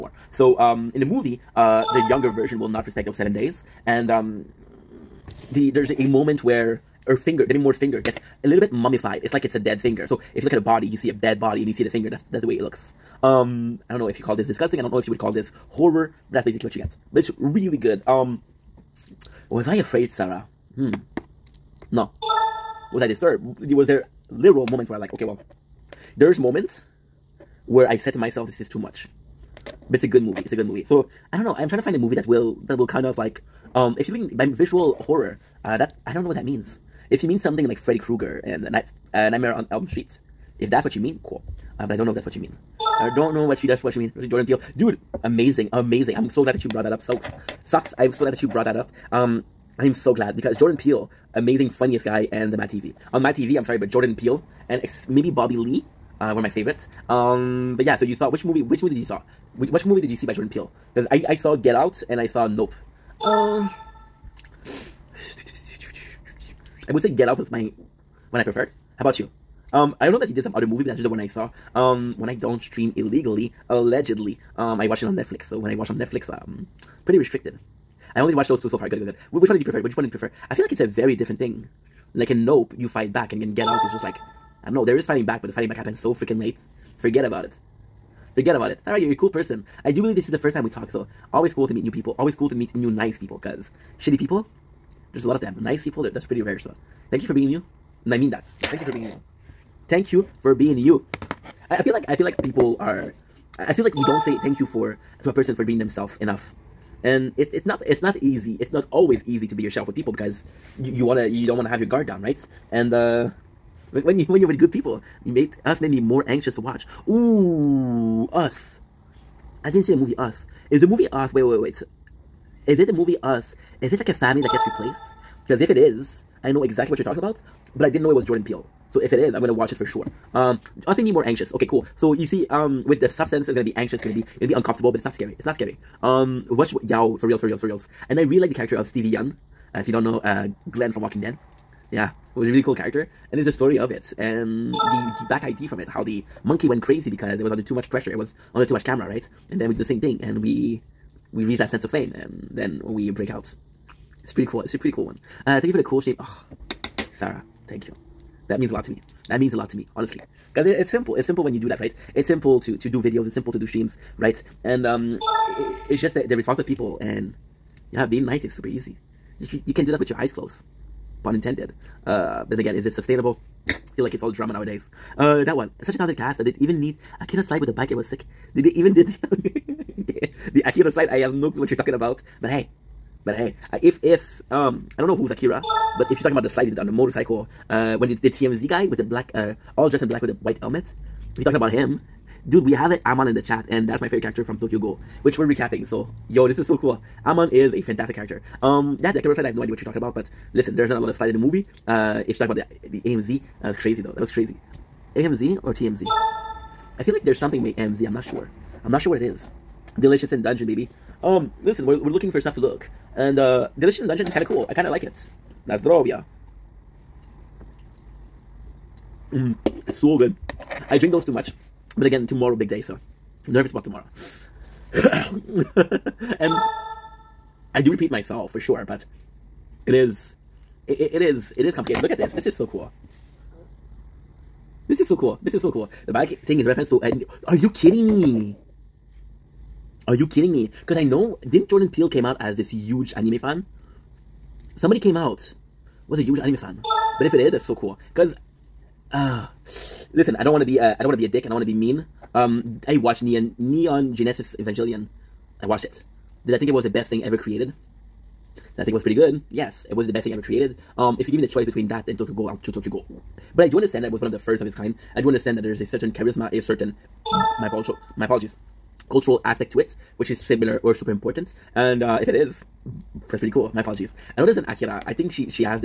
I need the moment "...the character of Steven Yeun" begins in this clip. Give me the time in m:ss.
2:18.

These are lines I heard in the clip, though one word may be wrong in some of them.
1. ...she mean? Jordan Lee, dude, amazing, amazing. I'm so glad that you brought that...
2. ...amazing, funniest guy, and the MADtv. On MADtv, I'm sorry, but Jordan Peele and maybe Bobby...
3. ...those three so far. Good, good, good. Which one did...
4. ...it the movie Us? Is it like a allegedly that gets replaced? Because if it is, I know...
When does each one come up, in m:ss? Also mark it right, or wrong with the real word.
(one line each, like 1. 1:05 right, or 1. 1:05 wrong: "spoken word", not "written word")
1. 0:43 wrong: "Peele", not "Lee"
2. 0:51 right
3. 1:18 wrong: "two", not "three"
4. 2:02 wrong: "family", not "allegedly".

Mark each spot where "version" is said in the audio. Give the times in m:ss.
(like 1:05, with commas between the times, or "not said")
0:02.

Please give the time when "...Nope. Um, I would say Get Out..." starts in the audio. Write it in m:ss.
1:02.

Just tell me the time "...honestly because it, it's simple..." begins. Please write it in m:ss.
2:39.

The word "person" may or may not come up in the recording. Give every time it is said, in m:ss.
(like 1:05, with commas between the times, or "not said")
1:29, 1:45.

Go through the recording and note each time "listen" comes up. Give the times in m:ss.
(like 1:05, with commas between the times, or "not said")
3:20, 3:31, 4:10.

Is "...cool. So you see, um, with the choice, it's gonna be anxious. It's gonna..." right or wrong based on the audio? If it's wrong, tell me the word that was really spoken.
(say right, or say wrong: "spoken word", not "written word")
wrong: "substance", not "choice".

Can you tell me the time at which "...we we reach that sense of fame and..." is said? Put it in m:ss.
2:30.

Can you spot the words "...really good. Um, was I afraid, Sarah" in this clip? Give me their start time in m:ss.
0:17.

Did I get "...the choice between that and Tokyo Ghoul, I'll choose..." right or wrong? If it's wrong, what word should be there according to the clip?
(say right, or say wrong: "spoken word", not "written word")
right.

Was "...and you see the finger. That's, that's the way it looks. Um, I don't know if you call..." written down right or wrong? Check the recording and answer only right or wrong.
right.